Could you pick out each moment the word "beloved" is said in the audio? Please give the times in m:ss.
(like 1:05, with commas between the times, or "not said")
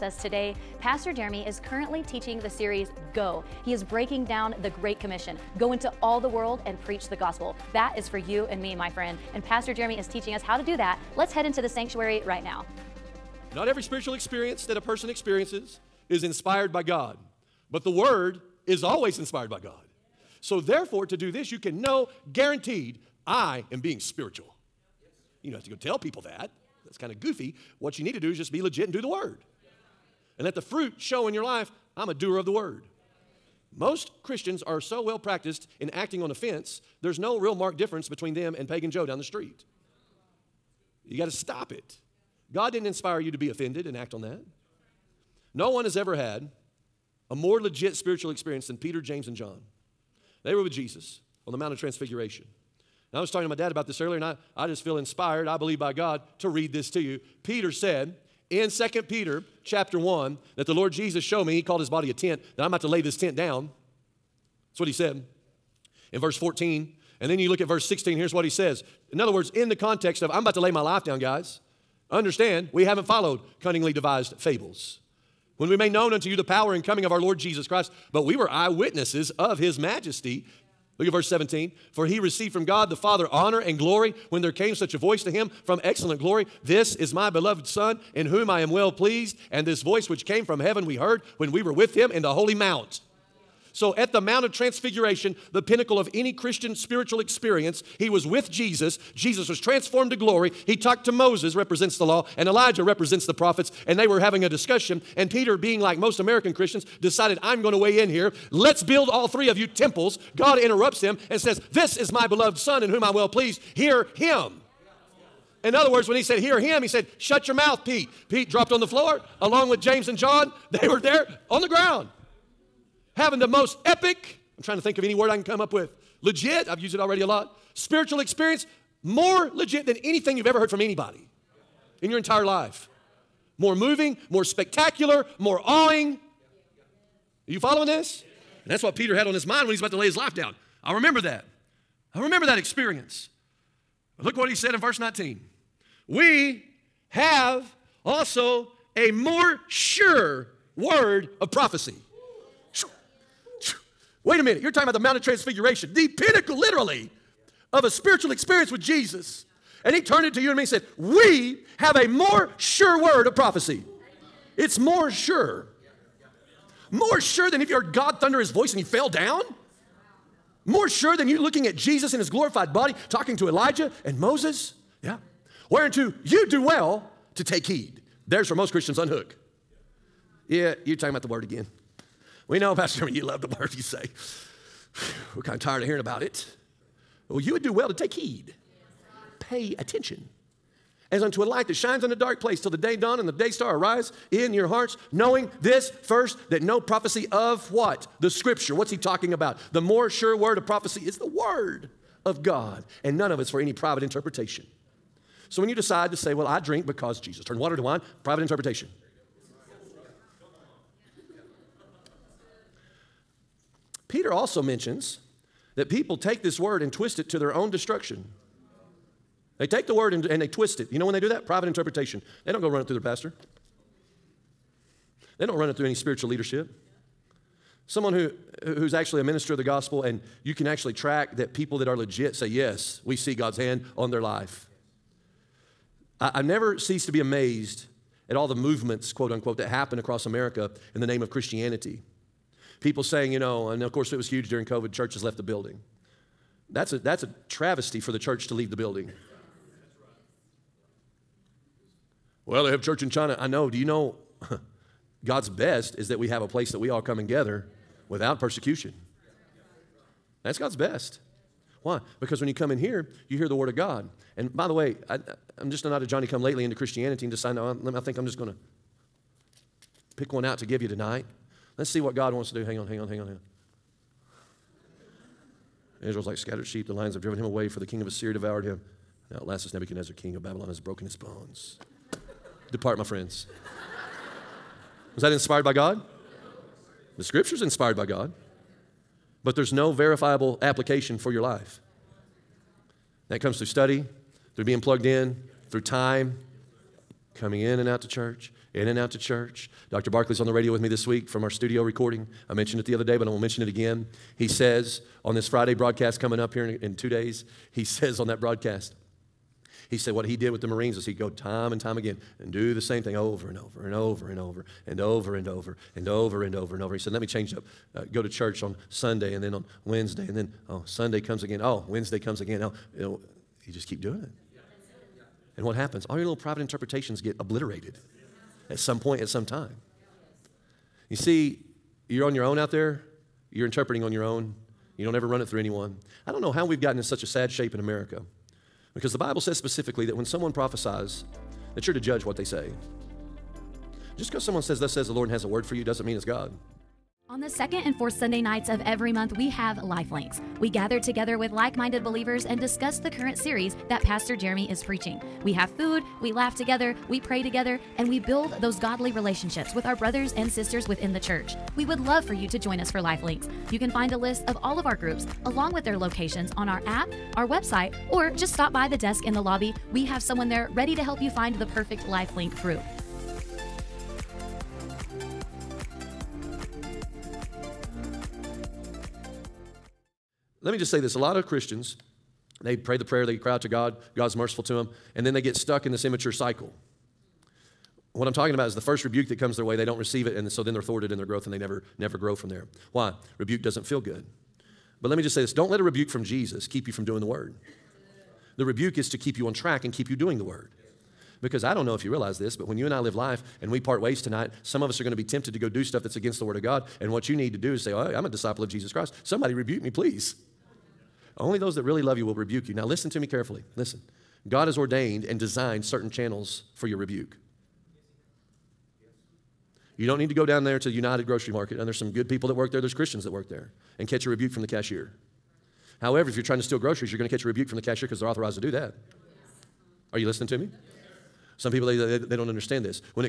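1:27, 1:52.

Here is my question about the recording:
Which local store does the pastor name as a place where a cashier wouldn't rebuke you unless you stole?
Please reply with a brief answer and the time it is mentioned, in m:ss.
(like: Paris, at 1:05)
United Grocery Market, at 7:00.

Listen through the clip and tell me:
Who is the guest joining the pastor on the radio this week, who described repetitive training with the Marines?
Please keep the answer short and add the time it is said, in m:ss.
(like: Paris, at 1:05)
Dr. Barkley, at 4:59.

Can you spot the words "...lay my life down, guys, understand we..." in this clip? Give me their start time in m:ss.
1:10.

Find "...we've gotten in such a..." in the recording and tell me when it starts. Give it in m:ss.
5:36.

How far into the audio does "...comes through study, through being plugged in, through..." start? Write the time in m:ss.
4:53.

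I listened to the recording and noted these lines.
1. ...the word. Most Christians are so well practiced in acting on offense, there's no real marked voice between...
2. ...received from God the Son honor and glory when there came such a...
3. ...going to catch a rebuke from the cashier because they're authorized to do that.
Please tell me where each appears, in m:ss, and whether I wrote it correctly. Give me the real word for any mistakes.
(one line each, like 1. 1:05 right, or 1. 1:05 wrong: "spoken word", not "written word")
1. 0:32 wrong: "difference", not "voice"
2. 1:22 wrong: "Father", not "Son"
3. 7:07 right.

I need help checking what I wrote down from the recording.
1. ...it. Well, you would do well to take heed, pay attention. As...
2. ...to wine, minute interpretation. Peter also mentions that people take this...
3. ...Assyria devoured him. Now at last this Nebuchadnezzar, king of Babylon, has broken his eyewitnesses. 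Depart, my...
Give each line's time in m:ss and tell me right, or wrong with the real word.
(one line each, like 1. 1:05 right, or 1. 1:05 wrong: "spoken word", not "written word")
1. 3:06 right
2. 3:27 wrong: "private", not "minute"
3. 4:38 wrong: "bones", not "eyewitnesses".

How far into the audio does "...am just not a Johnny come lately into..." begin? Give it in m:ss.
4:25.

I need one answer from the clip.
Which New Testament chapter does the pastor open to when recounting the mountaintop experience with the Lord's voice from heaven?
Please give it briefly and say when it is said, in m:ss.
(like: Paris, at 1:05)
2 Peter chapter 1, at 0:58.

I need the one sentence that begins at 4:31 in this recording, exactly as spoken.
Let's see what God wants to do.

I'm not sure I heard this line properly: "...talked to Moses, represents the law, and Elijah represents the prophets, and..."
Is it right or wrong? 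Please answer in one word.
right.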